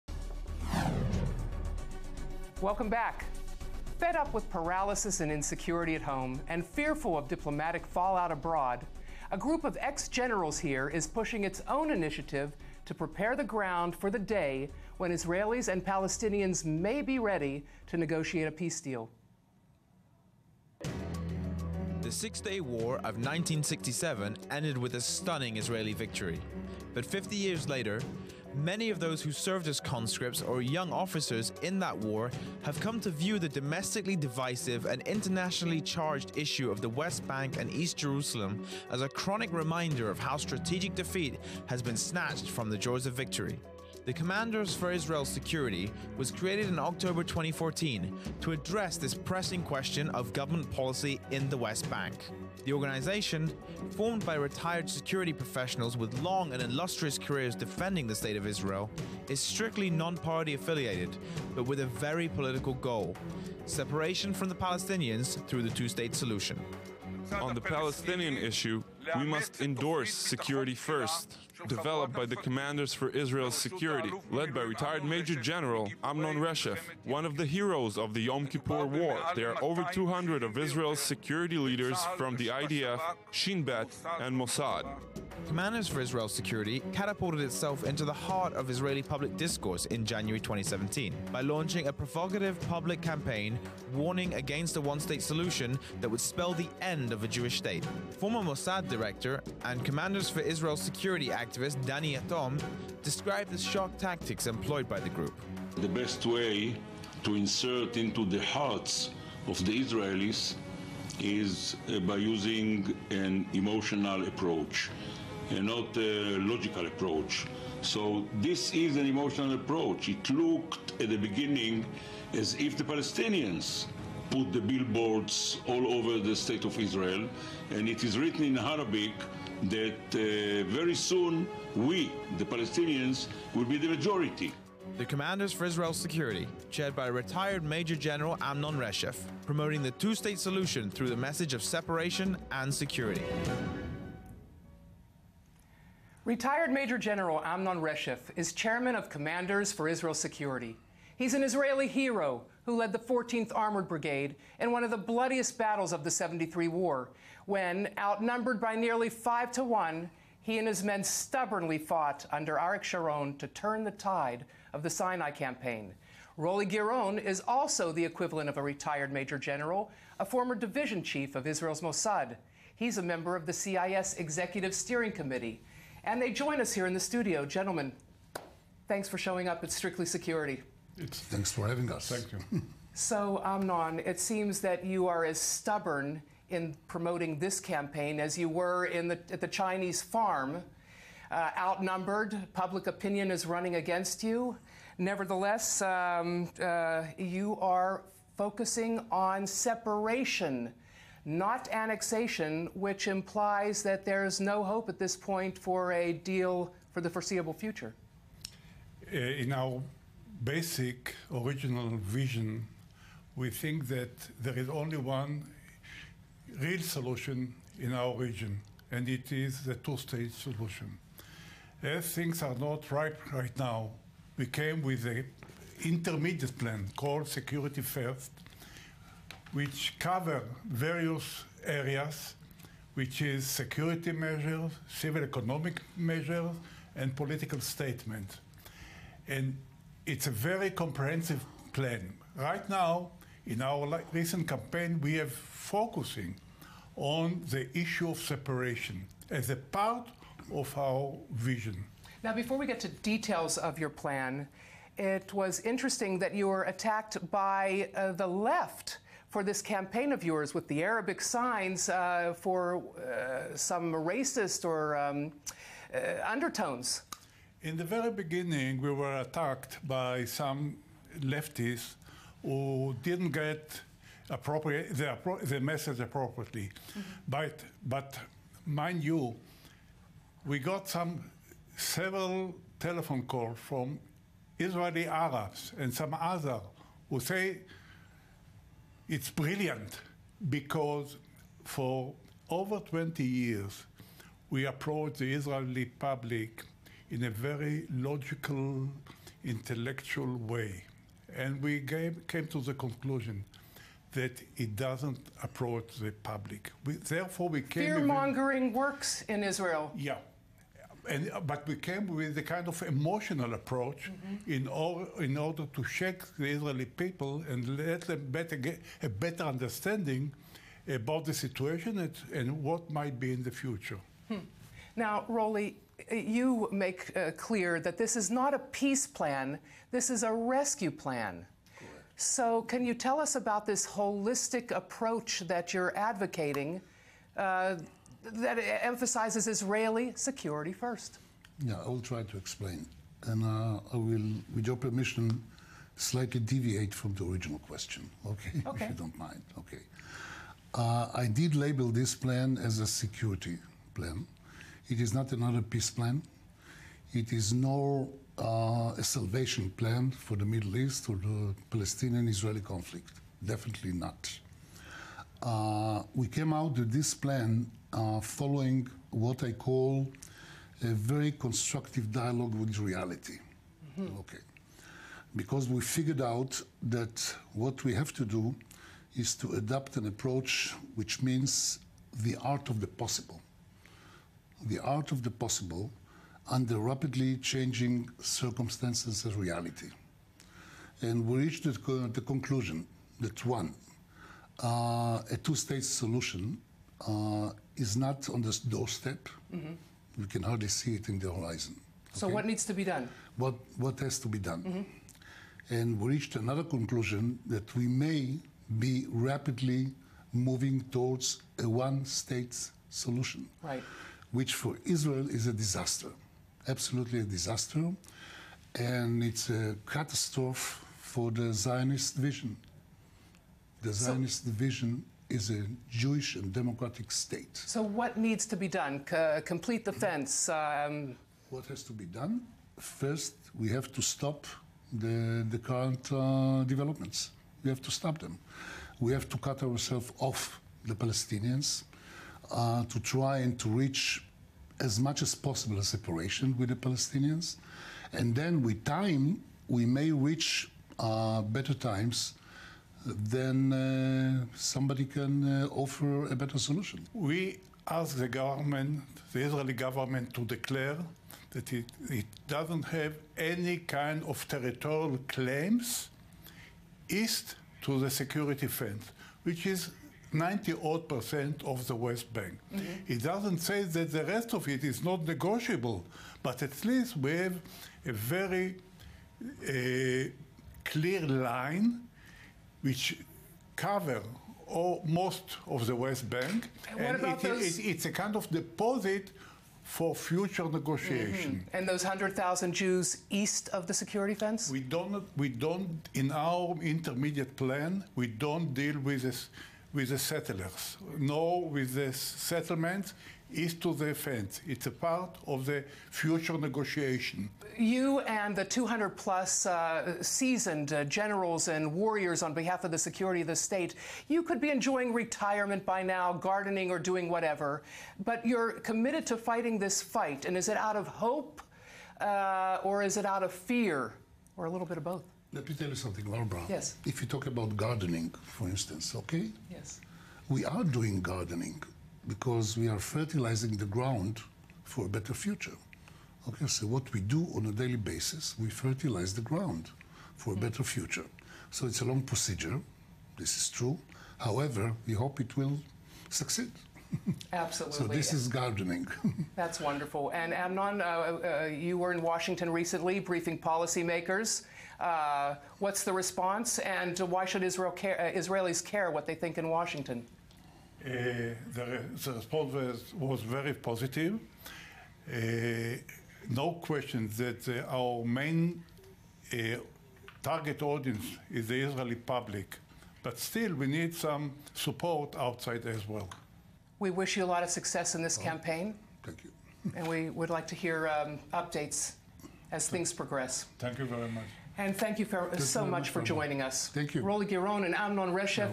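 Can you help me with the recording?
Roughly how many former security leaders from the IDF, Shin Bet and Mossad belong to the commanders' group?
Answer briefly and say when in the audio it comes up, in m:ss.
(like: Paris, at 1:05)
over 200, at 1:19.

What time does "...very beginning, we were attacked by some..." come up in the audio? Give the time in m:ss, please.
4:27.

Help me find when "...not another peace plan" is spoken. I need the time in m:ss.
5:55.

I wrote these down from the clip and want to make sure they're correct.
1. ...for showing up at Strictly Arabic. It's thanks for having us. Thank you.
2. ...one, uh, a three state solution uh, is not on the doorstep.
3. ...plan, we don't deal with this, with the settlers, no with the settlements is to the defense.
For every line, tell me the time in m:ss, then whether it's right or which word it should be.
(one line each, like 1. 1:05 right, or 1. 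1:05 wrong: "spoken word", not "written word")
1. 2:59 wrong: "Security", not "Arabic"
2. 6:33 wrong: "two", not "three"
3. 8:17 right.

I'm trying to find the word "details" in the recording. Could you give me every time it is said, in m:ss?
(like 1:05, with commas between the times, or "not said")
4:12.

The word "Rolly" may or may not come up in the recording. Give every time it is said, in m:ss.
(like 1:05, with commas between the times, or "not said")
2:46, 5:25, 9:47.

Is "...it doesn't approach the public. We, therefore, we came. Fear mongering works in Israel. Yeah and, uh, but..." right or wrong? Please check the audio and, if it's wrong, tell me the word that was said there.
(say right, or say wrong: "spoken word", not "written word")
right.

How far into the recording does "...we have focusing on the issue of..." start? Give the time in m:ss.
4:05.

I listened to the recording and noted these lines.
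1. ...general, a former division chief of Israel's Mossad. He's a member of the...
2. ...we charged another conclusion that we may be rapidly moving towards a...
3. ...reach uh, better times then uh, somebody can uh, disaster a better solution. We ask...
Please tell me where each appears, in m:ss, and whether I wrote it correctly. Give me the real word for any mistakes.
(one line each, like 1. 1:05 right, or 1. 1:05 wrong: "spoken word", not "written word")
1. 2:49 right
2. 6:45 wrong: "reached", not "charged"
3. 7:30 wrong: "offer", not "disaster".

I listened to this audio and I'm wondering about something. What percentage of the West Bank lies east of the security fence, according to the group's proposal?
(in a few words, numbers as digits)
98 percent.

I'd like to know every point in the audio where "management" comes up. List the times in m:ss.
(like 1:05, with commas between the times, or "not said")
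not said.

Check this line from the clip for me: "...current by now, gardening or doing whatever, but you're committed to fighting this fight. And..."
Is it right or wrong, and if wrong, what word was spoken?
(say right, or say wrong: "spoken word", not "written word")
wrong: "retirement", not "current".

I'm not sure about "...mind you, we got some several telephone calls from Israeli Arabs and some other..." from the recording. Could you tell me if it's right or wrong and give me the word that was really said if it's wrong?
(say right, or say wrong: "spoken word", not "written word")
right.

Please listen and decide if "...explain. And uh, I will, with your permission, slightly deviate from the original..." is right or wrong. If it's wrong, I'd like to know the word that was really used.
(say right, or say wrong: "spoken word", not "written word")
right.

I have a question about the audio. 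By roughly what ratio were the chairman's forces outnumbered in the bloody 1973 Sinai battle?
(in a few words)
5 to 1.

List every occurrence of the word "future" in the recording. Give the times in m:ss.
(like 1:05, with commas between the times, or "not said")
3:27, 5:23, 8:10, 8:26, 8:55, 9:00.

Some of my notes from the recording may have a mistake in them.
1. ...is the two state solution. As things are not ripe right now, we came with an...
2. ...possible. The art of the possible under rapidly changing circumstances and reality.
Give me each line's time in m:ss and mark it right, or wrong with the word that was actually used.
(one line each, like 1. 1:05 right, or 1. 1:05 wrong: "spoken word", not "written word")
1. 3:39 right
2. 6:22 right.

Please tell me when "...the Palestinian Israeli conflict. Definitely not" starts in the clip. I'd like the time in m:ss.
6:01.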